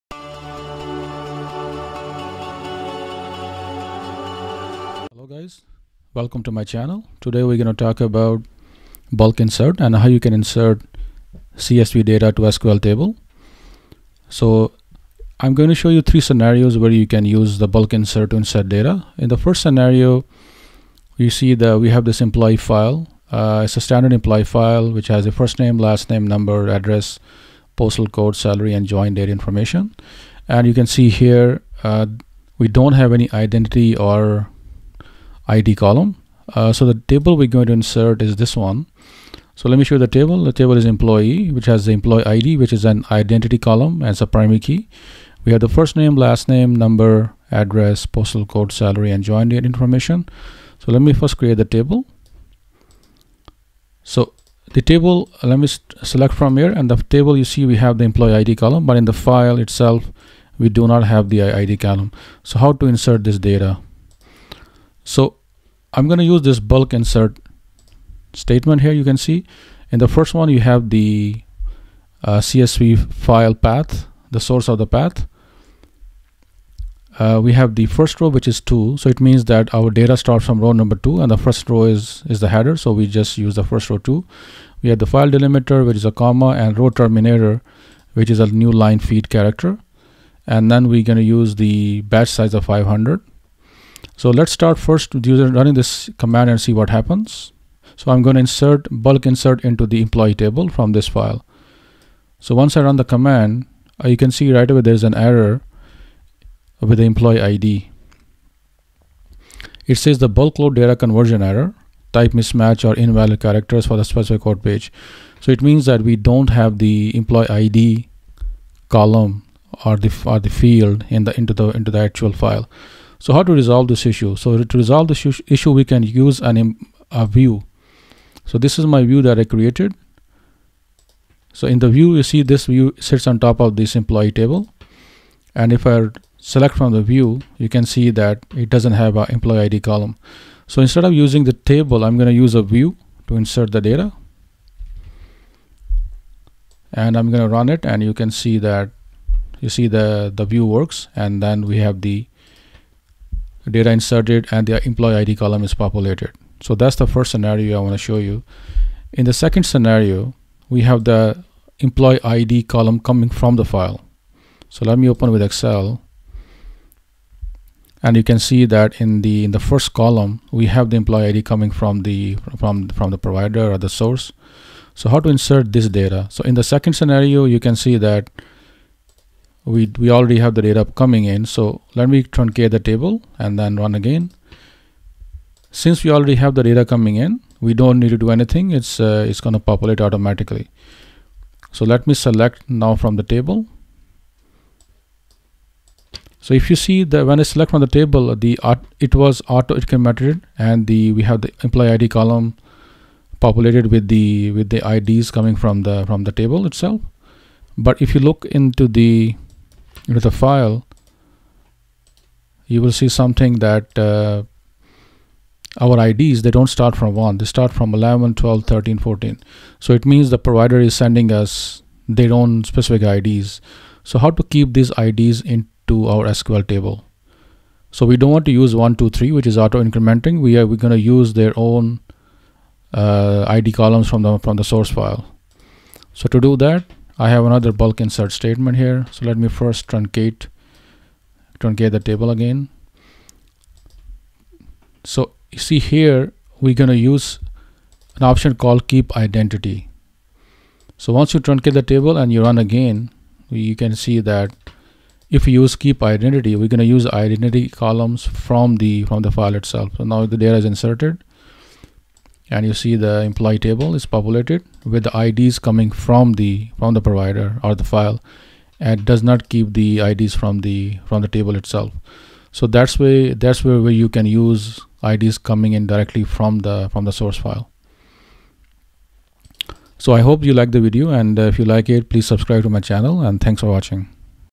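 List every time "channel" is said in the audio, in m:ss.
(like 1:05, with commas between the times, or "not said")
0:06, 4:42.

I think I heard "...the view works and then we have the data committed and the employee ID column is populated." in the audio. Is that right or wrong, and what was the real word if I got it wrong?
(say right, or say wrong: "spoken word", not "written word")
wrong: "inserted", not "committed".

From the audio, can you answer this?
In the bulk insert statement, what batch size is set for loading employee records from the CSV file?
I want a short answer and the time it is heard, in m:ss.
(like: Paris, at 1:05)
500, at 1:32.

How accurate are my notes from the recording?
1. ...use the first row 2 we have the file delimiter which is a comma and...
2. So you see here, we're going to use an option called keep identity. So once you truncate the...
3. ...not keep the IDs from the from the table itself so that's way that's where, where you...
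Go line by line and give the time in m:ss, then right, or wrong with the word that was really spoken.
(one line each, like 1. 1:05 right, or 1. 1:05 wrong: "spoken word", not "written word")
1. 1:23 right
2. 4:05 right
3. 4:29 right.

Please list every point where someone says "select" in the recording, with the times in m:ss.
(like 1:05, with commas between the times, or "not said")
0:56, 2:16, 3:12, 3:17.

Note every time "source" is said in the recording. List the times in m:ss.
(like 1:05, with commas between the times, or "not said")
1:14, 2:53, 3:54, 4:37.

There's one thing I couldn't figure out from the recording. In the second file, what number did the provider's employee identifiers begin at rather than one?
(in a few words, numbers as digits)
11.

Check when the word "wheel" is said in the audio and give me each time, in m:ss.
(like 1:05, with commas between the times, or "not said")
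not said.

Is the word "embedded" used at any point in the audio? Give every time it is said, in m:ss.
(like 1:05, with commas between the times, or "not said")
not said.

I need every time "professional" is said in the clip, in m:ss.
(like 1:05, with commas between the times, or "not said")
not said.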